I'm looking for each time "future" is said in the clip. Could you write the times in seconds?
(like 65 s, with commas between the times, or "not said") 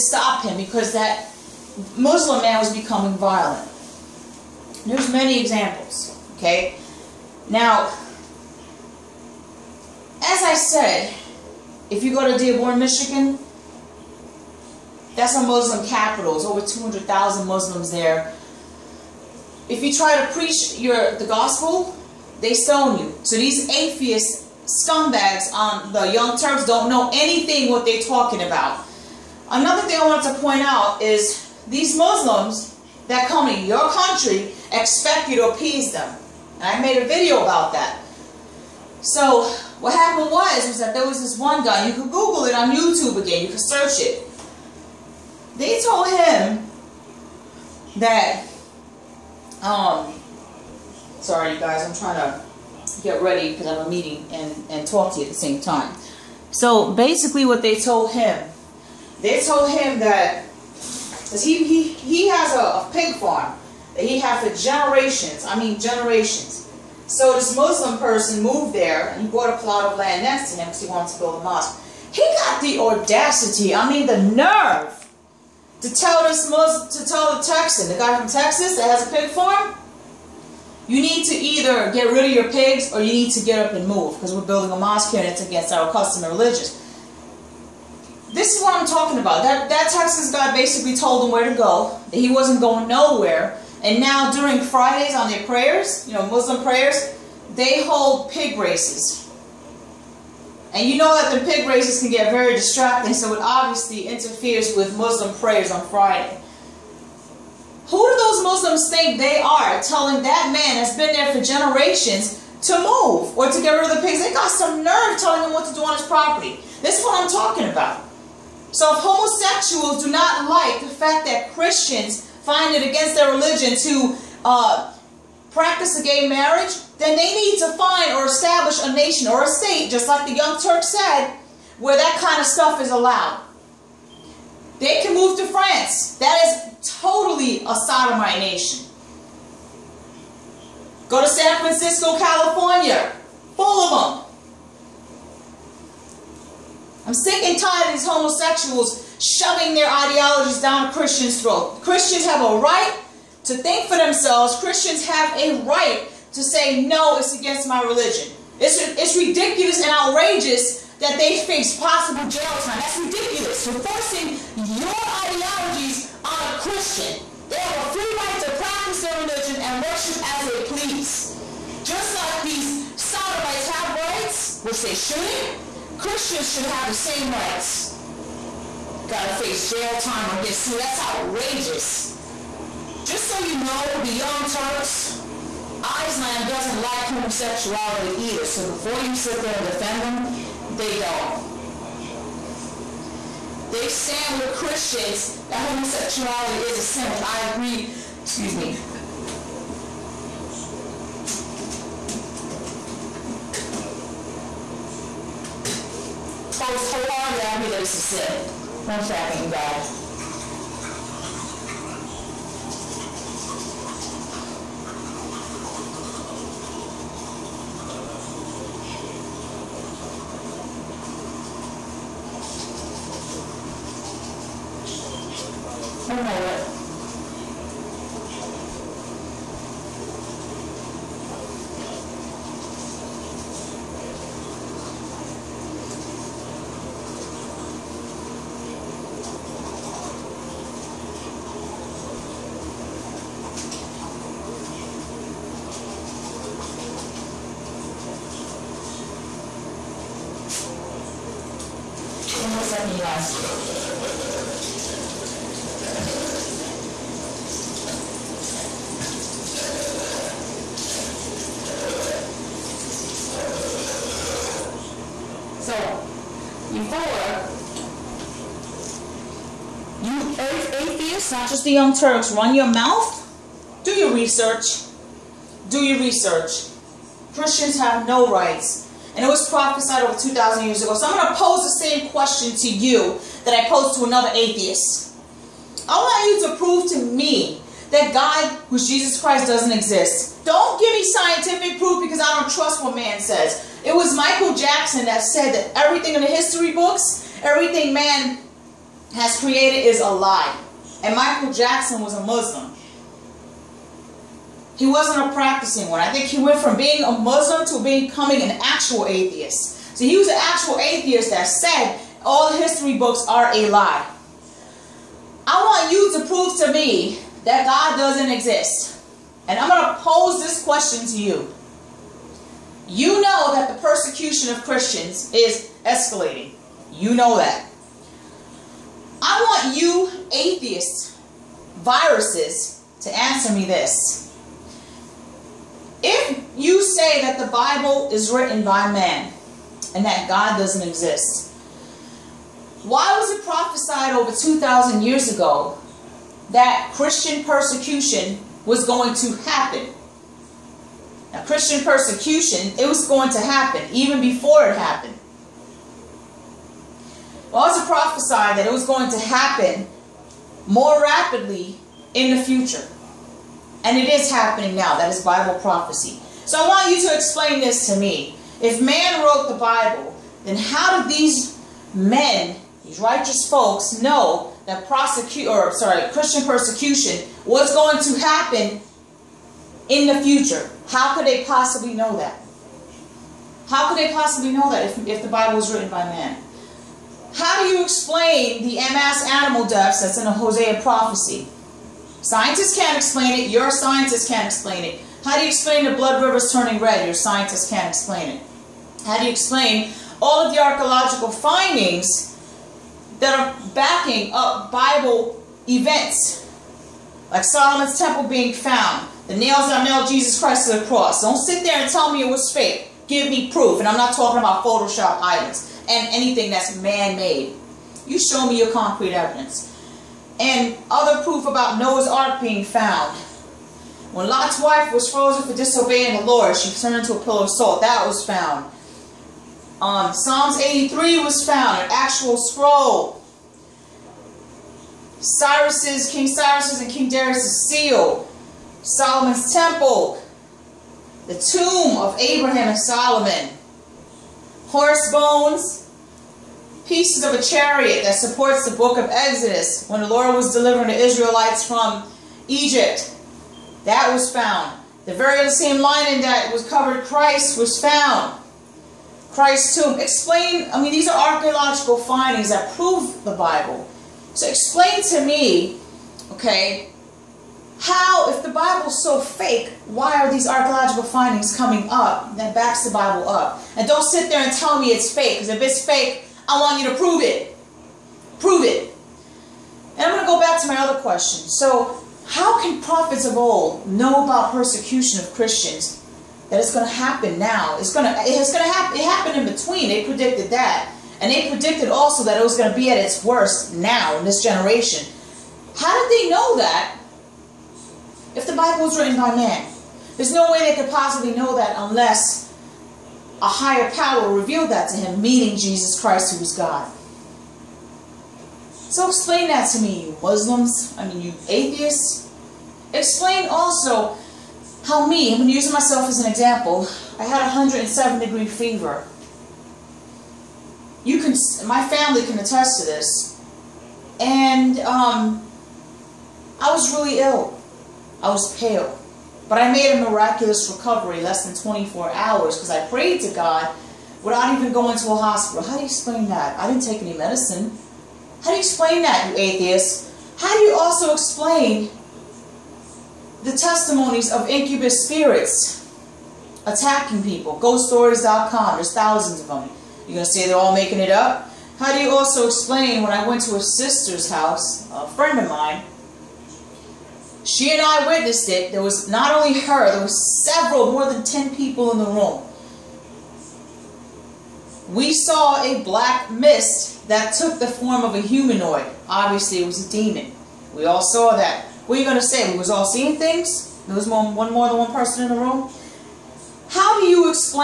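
362 s, 380 s.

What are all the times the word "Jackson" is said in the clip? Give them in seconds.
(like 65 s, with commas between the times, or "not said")
294 s, 301 s.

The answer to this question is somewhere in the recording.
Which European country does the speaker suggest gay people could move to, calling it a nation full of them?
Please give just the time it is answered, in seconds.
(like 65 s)
135 s.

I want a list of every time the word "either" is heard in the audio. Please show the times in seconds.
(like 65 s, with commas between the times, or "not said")
81 s, 188 s.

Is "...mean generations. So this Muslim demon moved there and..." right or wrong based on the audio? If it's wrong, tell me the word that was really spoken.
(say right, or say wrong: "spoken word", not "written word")
wrong: "person", not "demon".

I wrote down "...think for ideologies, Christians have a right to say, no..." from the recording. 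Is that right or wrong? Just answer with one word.
wrong.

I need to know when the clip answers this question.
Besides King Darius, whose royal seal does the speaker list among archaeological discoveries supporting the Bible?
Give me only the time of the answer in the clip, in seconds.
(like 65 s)
436 s.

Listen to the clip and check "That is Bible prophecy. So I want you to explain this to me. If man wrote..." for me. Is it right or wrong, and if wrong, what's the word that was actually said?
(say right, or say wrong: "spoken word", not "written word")
right.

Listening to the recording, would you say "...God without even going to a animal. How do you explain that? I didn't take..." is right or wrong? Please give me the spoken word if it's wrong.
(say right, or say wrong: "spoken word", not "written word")
wrong: "hospital", not "animal".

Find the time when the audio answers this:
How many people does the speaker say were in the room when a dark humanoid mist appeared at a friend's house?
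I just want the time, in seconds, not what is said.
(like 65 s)
560 s.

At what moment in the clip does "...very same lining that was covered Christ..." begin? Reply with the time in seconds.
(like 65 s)
455 s.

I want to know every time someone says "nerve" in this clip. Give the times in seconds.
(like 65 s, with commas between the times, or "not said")
74 s, 114 s.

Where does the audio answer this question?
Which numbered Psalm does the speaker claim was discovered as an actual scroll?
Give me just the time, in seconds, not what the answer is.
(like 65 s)
430 s.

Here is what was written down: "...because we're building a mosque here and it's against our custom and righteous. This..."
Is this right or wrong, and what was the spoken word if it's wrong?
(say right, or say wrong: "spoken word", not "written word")
wrong: "religious", not "righteous".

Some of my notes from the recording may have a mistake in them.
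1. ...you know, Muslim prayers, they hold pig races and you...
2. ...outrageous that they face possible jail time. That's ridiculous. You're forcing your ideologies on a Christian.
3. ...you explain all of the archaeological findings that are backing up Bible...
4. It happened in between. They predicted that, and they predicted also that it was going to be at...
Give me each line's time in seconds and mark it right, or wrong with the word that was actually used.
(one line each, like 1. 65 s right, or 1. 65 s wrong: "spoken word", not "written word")
1. 96 s right
2. 159 s right
3. 399 s right
4. 488 s right.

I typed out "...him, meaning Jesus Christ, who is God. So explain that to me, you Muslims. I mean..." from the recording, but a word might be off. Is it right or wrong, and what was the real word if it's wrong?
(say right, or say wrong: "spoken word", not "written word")
right.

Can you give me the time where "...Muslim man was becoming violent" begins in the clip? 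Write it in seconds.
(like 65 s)
1 s.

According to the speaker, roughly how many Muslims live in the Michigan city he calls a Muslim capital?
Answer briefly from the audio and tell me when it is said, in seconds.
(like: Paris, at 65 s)
over 200,000, at 16 s.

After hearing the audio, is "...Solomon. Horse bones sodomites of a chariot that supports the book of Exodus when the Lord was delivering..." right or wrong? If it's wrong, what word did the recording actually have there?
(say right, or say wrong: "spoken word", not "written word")
wrong: "pieces", not "sodomites".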